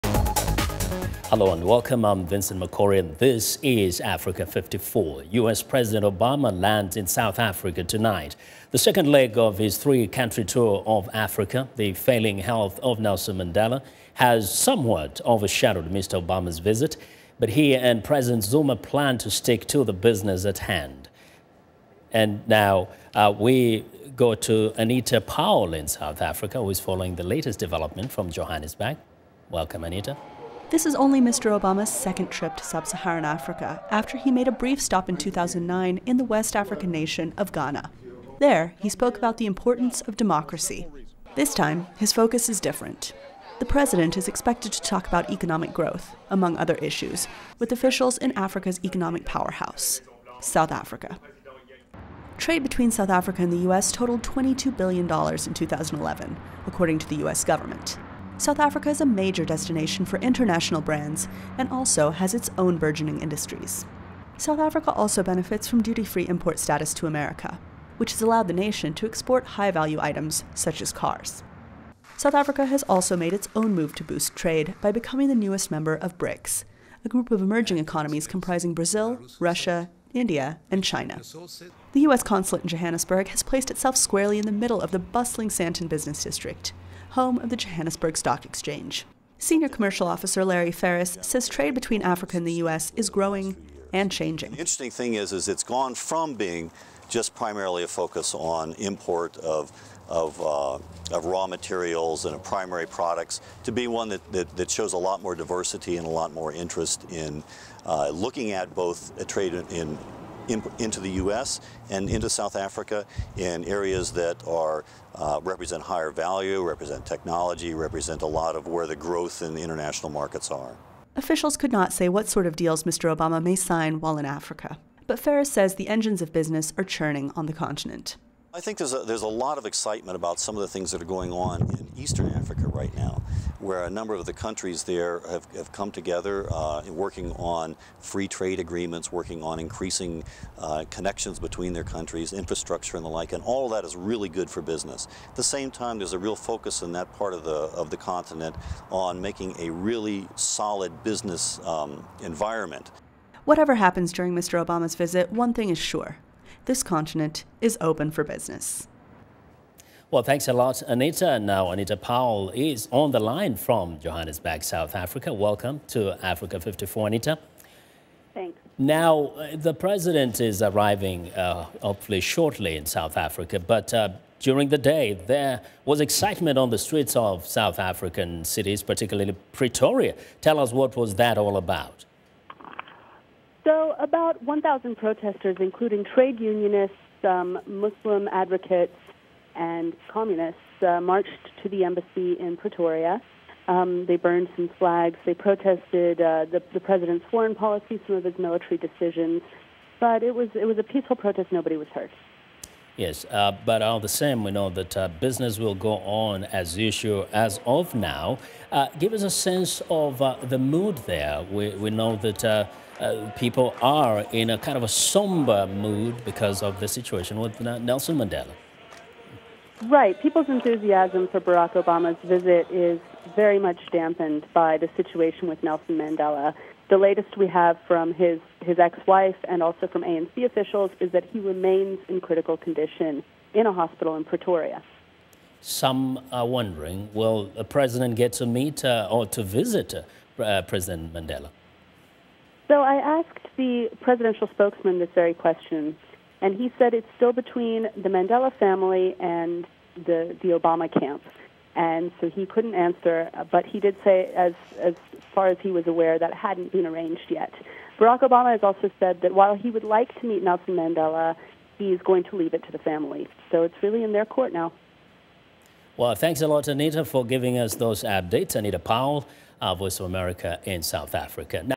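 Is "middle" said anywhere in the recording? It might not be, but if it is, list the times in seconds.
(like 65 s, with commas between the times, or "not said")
84 s.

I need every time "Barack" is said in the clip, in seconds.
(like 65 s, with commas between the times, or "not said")
221 s, 257 s.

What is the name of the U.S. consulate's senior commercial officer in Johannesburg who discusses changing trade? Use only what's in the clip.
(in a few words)
Larry Ferris.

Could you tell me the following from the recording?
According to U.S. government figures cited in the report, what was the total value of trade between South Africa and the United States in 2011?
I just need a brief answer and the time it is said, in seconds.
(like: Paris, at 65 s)
$22 billion, at 54 s.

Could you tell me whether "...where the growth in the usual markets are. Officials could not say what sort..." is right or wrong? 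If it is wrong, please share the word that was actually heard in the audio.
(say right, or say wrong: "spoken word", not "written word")
wrong: "international", not "usual".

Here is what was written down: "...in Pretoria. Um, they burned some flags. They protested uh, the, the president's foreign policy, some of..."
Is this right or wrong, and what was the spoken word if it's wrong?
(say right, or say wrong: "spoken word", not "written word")
right.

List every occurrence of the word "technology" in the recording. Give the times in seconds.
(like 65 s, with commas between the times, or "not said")
117 s.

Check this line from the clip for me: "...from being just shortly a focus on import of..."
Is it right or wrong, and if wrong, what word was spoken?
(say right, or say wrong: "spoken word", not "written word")
wrong: "primarily", not "shortly".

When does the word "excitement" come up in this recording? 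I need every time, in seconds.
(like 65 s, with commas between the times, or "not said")
129 s, 176 s.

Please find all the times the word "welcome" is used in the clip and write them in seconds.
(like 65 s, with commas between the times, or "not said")
1 s, 29 s, 165 s.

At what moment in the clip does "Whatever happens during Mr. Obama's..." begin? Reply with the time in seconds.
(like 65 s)
153 s.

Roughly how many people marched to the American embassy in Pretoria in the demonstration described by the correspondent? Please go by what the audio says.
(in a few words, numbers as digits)
1,000.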